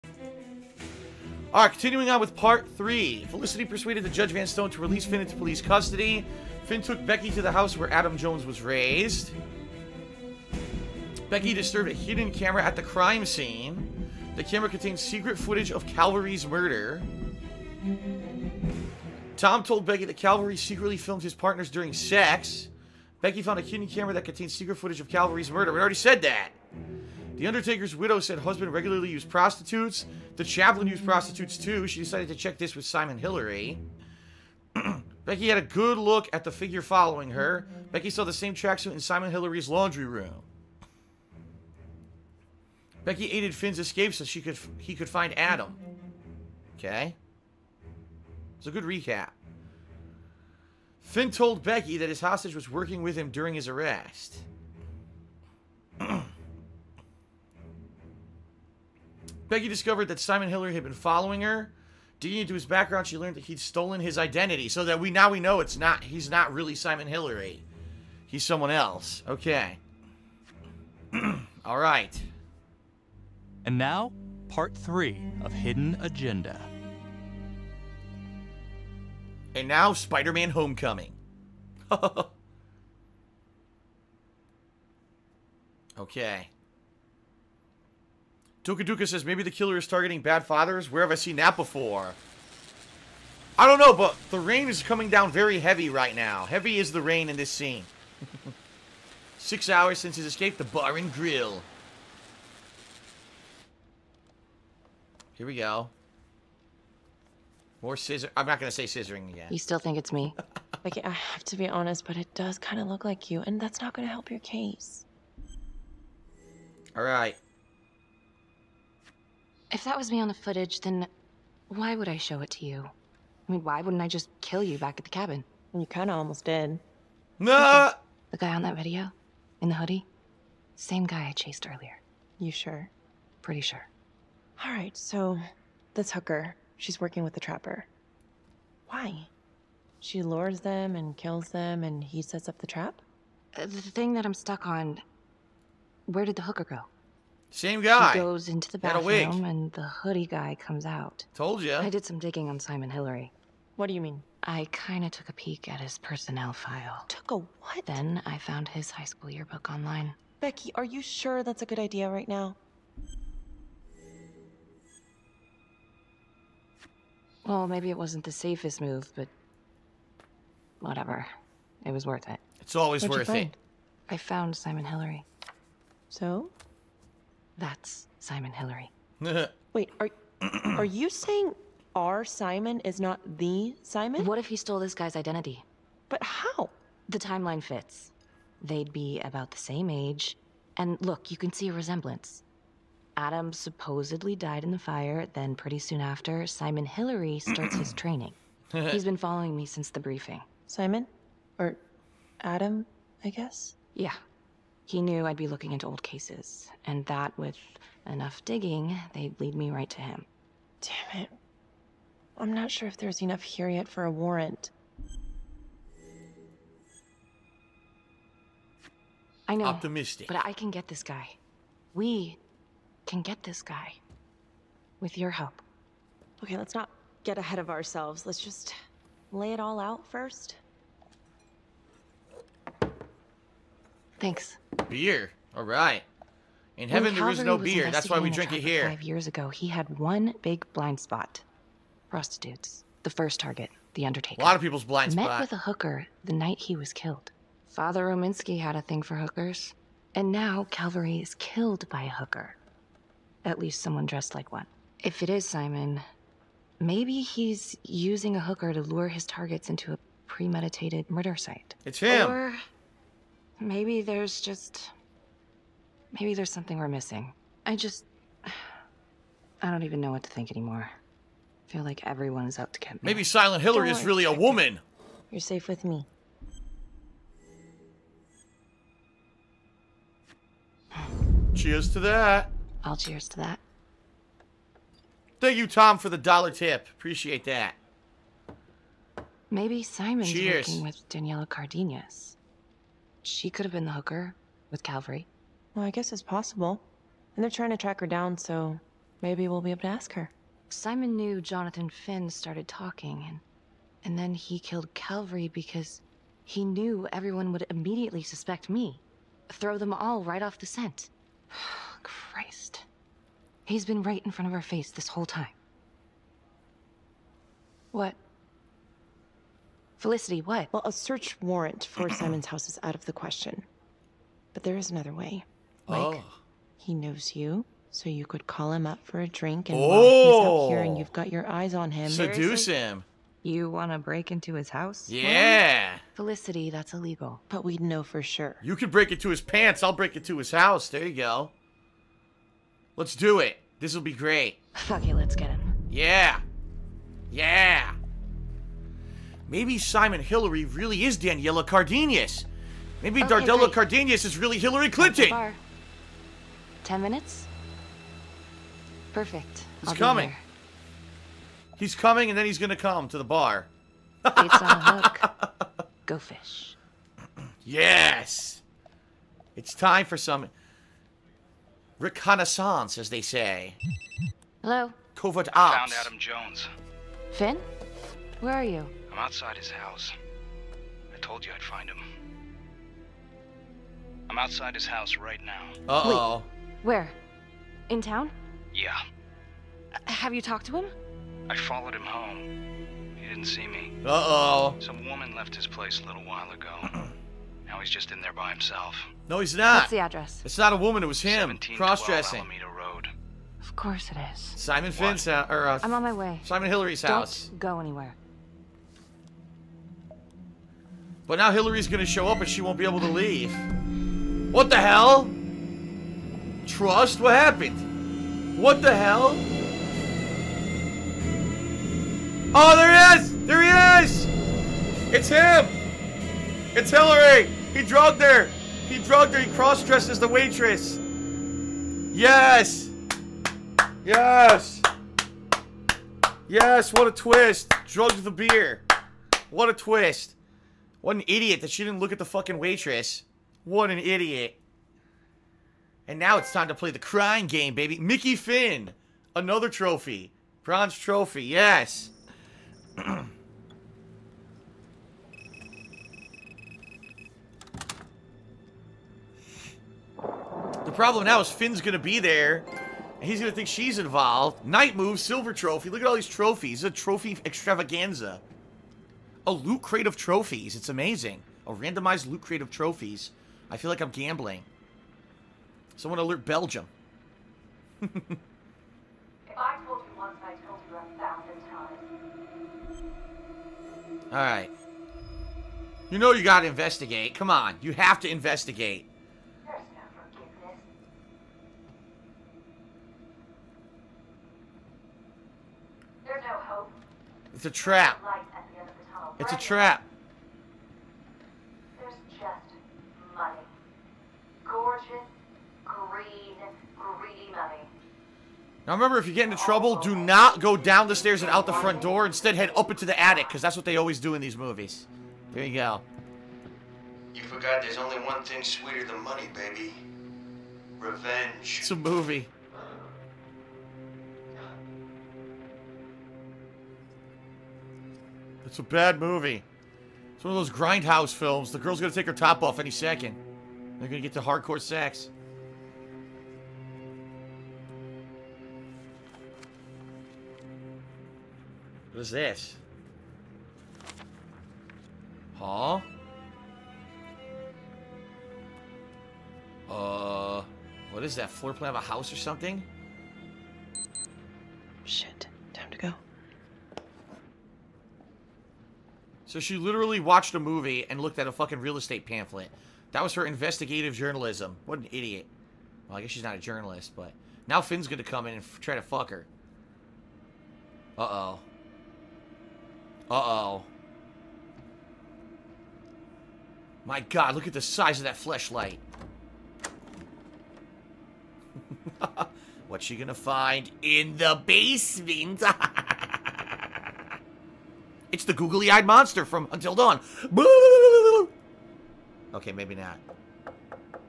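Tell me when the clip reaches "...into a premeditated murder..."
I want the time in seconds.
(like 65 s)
259 s.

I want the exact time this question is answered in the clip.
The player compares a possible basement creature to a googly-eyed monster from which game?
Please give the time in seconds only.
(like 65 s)
589 s.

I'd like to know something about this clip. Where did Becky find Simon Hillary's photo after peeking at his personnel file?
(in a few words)
High school yearbook.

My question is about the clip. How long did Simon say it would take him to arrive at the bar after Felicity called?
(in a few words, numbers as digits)
Ten minutes.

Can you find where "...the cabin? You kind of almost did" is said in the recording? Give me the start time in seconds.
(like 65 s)
125 s.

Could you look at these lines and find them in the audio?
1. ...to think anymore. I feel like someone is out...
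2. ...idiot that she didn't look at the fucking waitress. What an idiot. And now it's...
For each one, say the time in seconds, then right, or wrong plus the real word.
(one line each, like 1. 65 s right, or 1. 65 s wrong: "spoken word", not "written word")
1. 270 s wrong: "everyone", not "someone"
2. 441 s right.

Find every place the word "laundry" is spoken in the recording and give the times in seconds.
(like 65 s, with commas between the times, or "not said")
39 s.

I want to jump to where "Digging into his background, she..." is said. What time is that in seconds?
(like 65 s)
62 s.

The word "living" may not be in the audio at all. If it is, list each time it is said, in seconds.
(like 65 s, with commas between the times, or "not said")
not said.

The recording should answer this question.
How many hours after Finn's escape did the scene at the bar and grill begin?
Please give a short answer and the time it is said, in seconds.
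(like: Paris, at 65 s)
Six hours, at 99 s.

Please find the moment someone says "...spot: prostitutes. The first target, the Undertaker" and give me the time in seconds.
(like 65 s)
240 s.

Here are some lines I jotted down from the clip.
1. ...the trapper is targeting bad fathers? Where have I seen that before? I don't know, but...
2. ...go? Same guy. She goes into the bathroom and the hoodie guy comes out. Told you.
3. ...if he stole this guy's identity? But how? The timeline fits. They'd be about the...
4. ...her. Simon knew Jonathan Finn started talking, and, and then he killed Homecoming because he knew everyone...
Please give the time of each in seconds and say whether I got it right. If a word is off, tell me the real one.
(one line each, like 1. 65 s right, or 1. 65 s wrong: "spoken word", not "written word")
1. 89 s wrong: "killer", not "trapper"
2. 146 s right
3. 184 s right
4. 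300 s wrong: "Calvary", not "Homecoming".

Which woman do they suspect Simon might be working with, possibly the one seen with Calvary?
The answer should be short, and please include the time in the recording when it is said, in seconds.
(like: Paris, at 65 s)
Daniela Cardenas, at 291 s.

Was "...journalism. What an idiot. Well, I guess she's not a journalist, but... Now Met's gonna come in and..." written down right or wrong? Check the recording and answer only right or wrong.
wrong.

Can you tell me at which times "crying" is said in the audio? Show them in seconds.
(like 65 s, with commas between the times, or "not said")
446 s.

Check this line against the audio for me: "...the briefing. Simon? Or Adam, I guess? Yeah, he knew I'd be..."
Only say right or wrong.
right.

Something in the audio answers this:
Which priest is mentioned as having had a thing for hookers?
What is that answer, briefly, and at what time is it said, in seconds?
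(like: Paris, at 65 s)
Father Rominsky, at 247 s.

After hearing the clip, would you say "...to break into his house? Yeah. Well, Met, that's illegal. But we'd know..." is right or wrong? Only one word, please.
wrong.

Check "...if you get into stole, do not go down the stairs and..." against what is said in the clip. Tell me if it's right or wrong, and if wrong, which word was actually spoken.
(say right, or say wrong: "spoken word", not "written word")
wrong: "trouble", not "stole".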